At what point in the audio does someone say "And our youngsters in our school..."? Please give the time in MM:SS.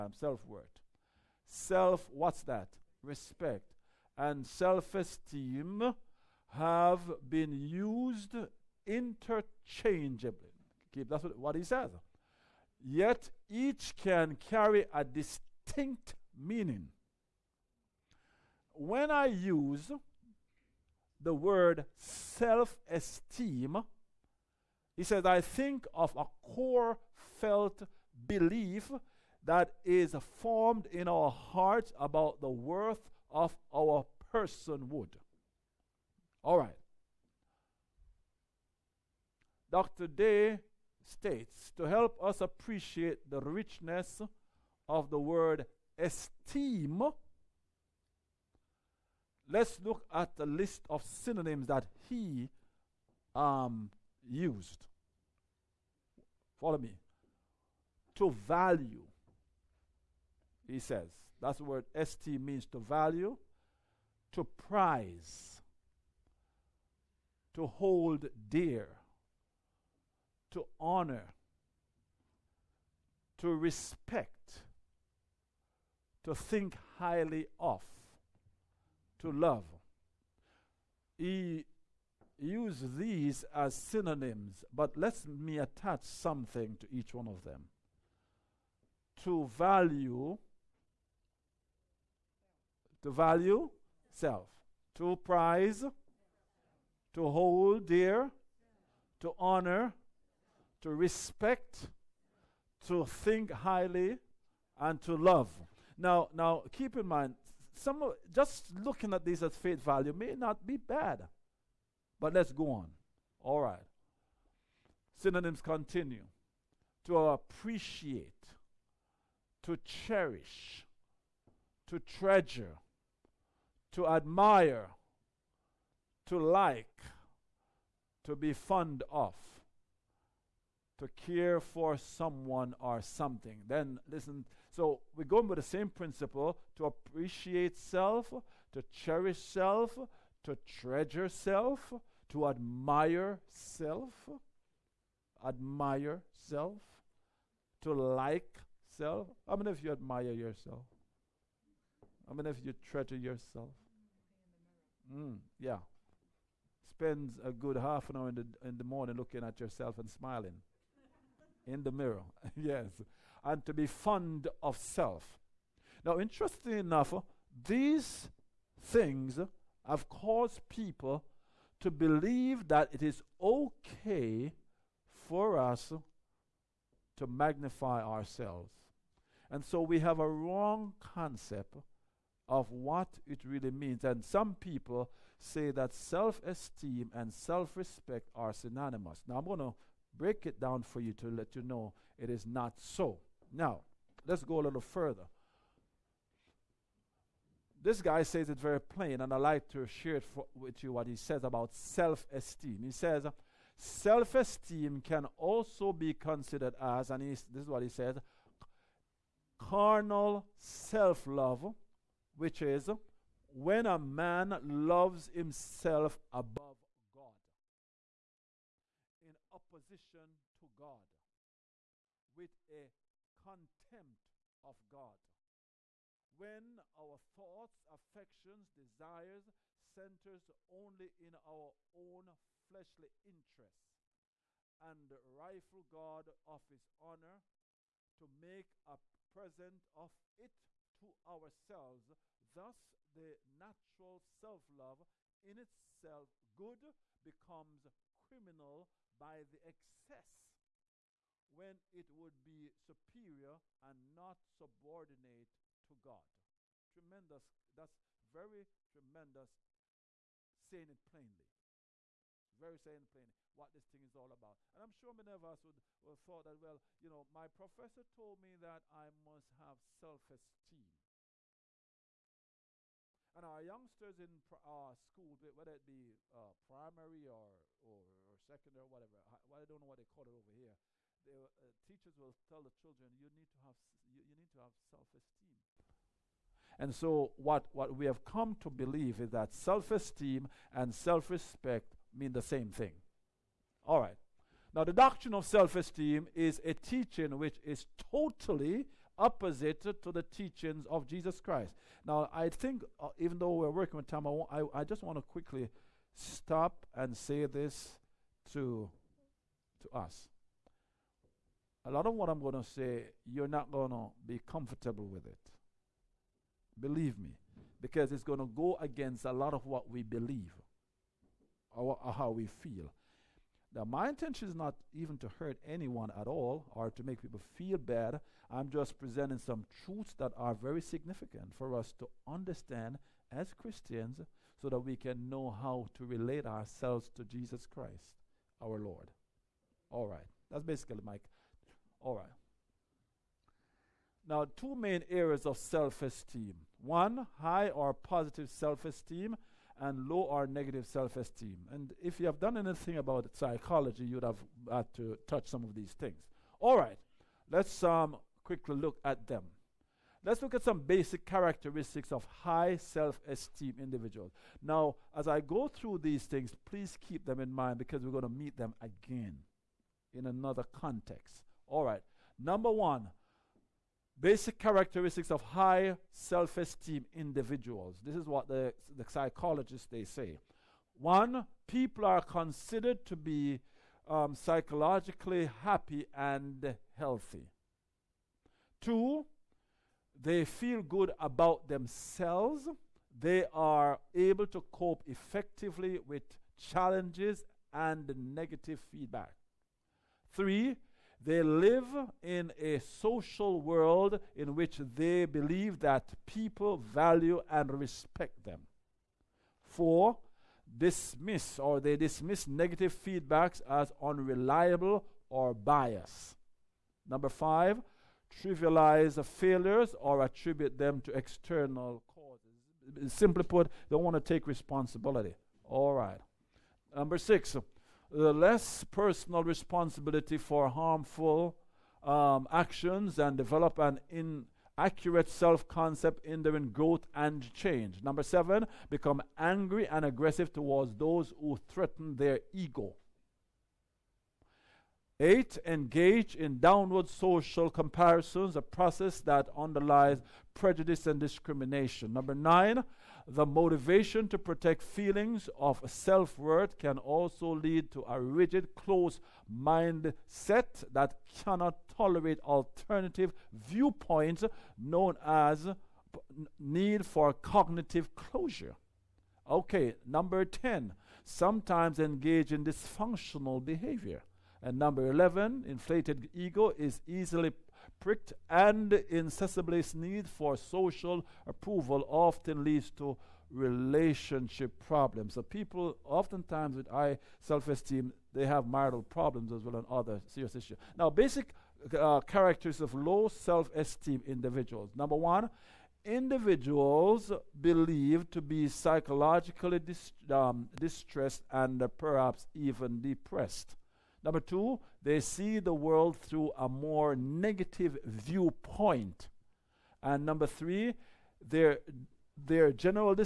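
04:33.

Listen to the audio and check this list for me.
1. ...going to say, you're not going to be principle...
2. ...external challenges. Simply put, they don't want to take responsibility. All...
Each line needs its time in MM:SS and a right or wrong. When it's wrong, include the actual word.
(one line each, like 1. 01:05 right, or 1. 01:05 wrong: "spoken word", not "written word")
1. 05:12 wrong: "comfortable", not "principle"
2. 07:01 wrong: "causes", not "challenges".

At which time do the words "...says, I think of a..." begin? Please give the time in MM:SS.
00:25.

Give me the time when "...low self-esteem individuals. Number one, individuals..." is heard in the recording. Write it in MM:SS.
08:12.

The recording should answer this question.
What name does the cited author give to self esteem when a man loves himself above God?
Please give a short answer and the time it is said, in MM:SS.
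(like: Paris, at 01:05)
carnal self love, at 03:29.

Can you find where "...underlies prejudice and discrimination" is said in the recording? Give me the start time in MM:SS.
07:29.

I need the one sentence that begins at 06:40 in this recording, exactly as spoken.
Three, they live in a social world in which they believe that people value and respect them.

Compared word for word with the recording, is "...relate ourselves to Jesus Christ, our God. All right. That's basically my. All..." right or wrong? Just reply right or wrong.
wrong.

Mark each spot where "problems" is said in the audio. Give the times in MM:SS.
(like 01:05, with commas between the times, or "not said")
08:04, 08:09.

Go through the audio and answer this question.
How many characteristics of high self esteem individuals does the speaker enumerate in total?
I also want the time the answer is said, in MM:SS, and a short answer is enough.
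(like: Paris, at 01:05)
11, at 07:55.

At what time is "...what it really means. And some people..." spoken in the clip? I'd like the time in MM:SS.
03:02.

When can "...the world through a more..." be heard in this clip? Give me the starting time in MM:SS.
08:25.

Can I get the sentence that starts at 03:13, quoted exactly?
Now, let's go a little further.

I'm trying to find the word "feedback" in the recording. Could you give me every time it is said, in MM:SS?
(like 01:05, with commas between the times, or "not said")
06:38, 06:53.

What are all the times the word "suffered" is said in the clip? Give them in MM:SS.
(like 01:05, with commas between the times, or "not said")
not said.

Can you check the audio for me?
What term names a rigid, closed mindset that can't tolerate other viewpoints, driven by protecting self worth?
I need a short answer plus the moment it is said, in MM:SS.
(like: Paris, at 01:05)
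need for cognitive closure, at 07:46.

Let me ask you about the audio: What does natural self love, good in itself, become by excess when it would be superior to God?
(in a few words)
criminal.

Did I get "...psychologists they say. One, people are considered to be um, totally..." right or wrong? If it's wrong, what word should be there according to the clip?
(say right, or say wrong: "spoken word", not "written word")
wrong: "psychologically", not "totally".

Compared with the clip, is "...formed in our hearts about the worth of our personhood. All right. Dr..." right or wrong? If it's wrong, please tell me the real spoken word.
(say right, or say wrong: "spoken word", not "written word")
right.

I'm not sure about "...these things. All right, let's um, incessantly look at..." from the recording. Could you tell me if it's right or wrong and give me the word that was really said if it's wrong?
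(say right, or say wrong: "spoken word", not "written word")
wrong: "quickly", not "incessantly".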